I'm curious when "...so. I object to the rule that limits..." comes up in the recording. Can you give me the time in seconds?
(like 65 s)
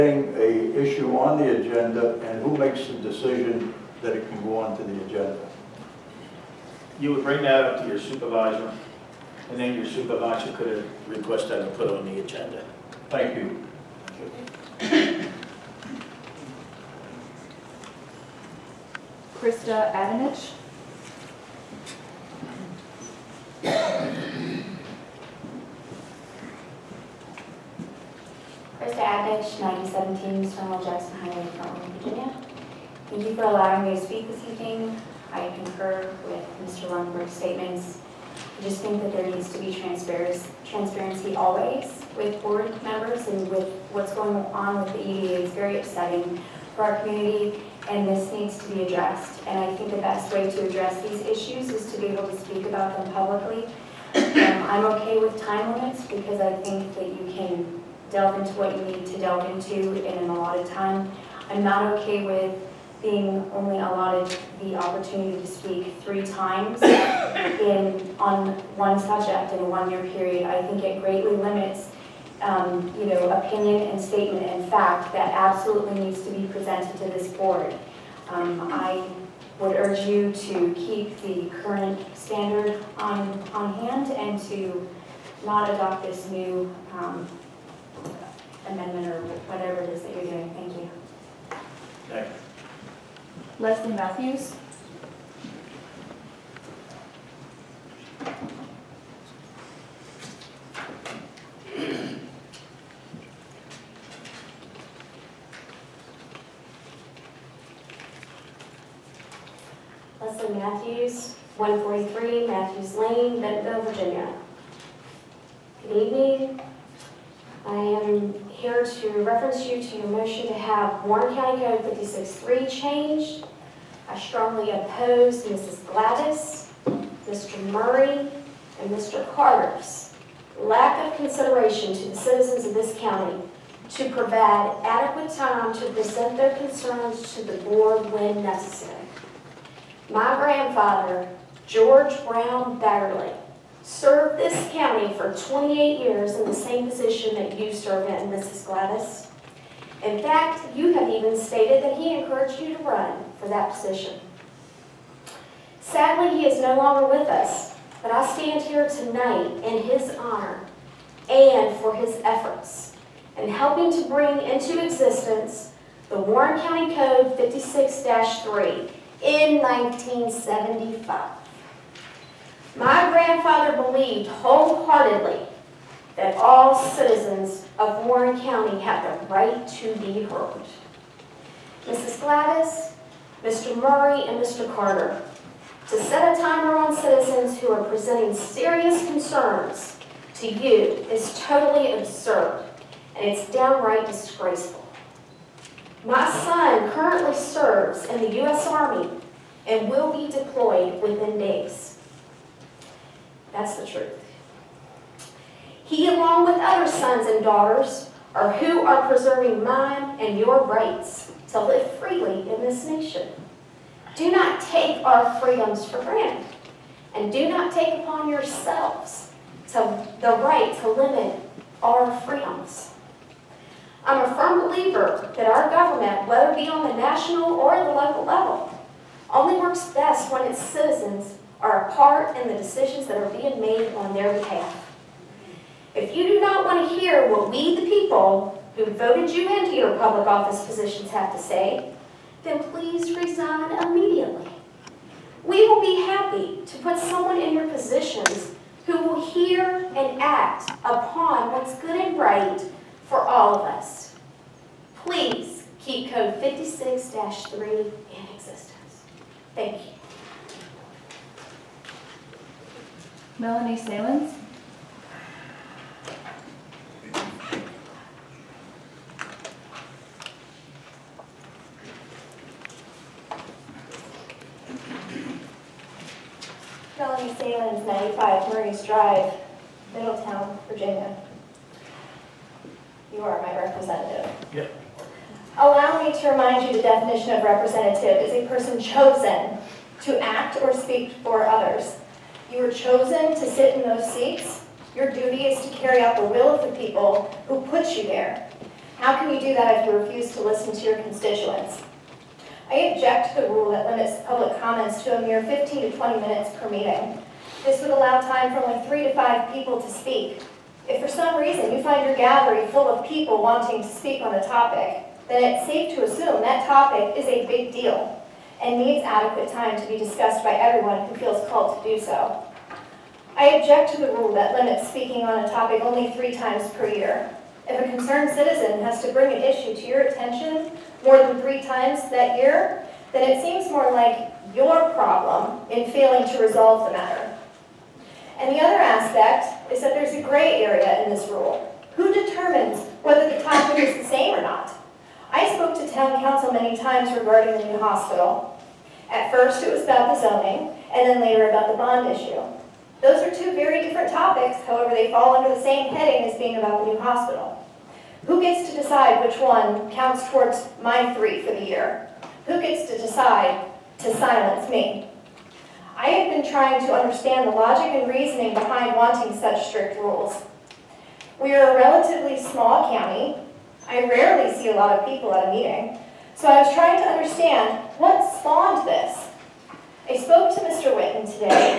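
322 s.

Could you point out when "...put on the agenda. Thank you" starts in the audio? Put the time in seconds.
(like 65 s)
11 s.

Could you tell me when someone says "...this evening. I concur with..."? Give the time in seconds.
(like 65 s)
34 s.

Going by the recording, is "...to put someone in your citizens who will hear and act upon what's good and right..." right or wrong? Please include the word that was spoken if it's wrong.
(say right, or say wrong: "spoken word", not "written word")
wrong: "positions", not "citizens".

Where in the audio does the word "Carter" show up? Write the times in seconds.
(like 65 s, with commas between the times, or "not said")
129 s, 184 s.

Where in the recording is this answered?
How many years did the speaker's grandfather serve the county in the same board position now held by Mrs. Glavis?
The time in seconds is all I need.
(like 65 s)
145 s.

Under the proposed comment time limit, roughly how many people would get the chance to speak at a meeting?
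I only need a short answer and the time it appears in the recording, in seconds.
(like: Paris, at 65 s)
3 to 5, at 308 s.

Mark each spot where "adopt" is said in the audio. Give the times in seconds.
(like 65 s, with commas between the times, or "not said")
85 s.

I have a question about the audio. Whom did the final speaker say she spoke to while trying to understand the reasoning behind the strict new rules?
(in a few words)
Mr. Whitten.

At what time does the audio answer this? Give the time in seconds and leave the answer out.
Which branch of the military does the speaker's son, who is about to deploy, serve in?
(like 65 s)
198 s.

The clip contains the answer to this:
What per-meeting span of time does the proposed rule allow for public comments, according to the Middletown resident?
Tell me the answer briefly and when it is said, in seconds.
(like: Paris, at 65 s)
15 to 20 minutes, at 305 s.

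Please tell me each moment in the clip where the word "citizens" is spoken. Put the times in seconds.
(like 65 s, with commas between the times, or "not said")
132 s, 176 s, 186 s, 230 s, 328 s.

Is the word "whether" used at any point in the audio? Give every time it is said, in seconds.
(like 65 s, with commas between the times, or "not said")
226 s, 343 s.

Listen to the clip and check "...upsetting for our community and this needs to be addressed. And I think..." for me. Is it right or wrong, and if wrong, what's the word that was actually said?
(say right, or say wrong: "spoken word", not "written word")
right.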